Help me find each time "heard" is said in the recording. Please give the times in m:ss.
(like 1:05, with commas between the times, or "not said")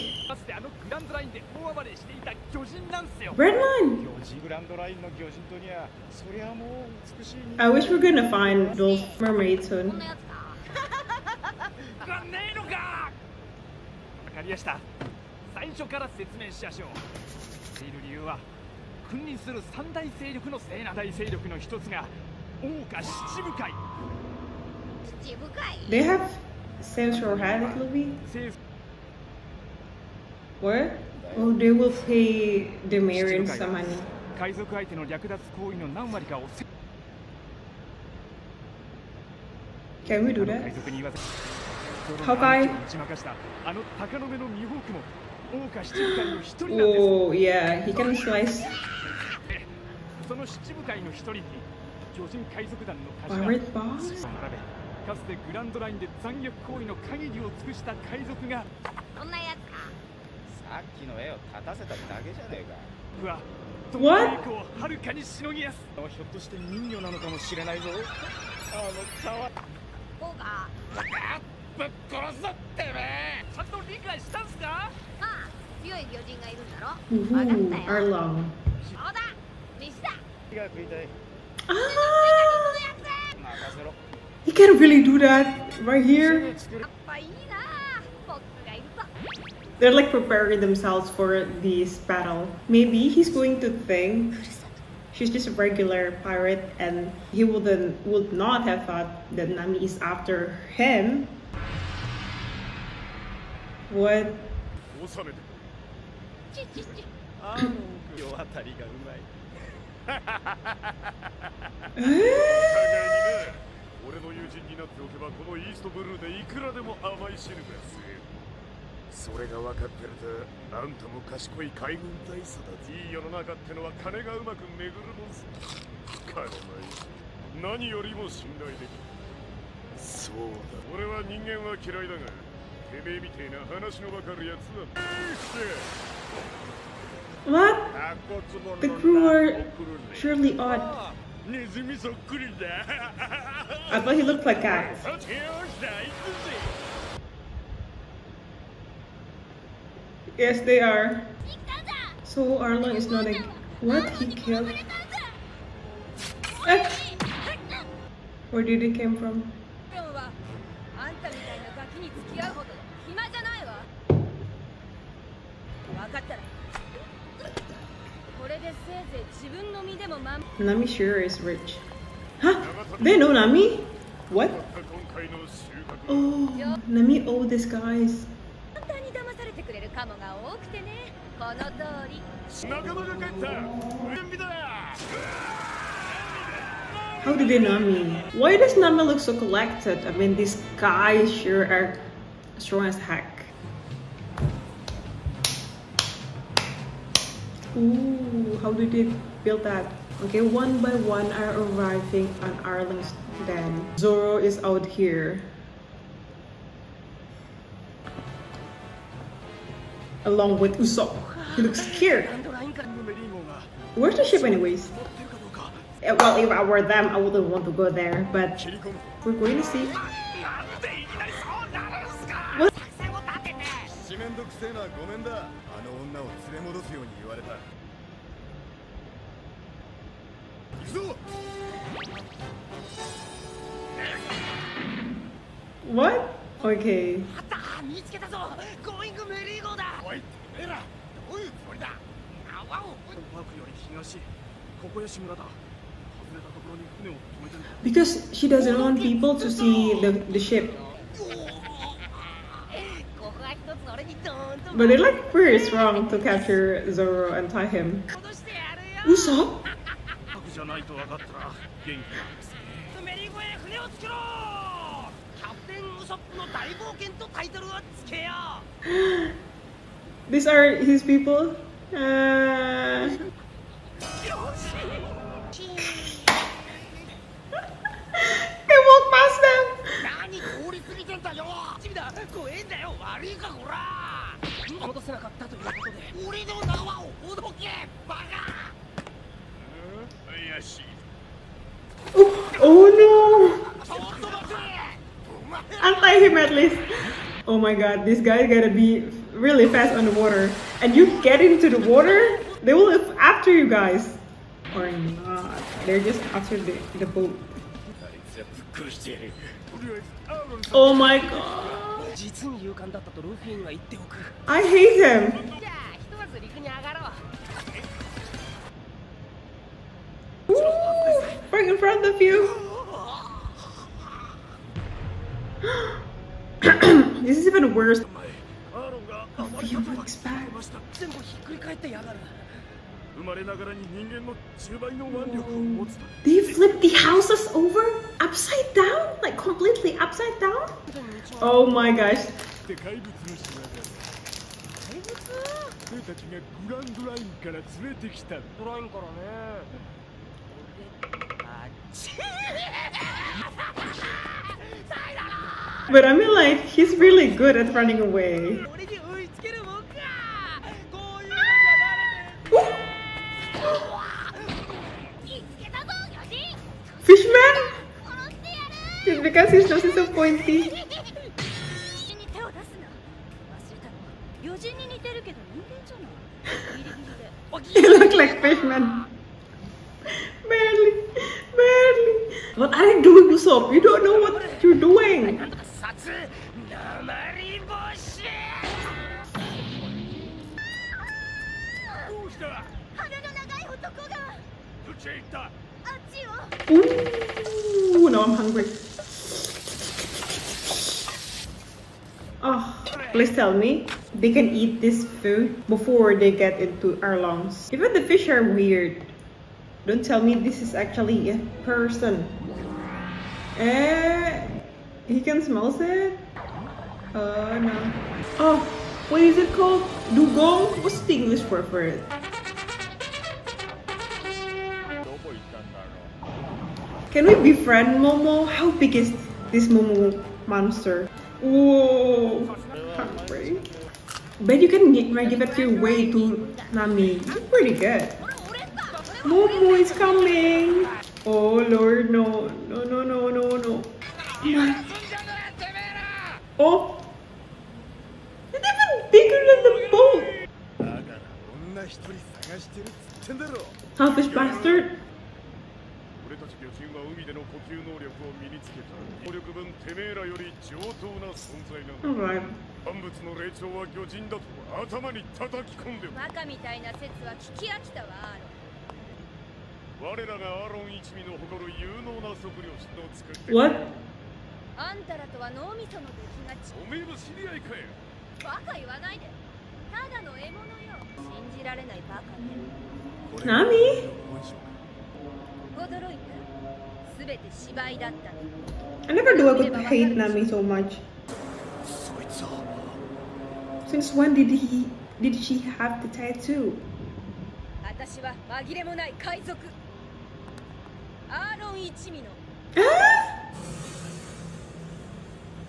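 not said.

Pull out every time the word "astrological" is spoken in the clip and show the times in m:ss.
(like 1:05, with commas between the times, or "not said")
not said.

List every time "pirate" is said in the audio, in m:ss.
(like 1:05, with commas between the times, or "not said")
0:53, 1:36.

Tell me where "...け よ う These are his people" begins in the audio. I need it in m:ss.
4:28.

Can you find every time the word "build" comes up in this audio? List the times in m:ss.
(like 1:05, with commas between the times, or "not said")
3:19.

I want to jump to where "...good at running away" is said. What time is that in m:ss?
5:57.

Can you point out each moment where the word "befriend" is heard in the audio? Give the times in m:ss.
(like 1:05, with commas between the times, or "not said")
7:07.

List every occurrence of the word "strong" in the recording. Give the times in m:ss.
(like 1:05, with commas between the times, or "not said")
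3:12, 4:15.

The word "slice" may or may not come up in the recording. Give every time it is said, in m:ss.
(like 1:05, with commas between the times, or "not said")
0:48.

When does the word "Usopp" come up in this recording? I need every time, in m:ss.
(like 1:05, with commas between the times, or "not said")
3:30, 4:19, 6:23.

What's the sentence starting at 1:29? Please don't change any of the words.
They're like preparing themselves for this battle.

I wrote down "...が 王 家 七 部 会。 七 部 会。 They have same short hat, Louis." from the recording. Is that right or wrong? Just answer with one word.
right.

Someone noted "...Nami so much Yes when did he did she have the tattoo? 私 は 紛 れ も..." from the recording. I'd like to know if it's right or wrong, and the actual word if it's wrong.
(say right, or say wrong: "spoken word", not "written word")
wrong: "Since", not "Yes".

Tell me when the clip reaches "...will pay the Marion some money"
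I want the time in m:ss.
0:31.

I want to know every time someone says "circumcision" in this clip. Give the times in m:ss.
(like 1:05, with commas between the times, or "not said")
not said.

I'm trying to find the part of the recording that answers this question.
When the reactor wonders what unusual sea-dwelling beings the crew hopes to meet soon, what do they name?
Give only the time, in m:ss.
0:09.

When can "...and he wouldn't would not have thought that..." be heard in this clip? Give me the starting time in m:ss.
1:36.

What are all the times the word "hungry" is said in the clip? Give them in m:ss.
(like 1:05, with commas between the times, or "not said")
6:38, 7:12.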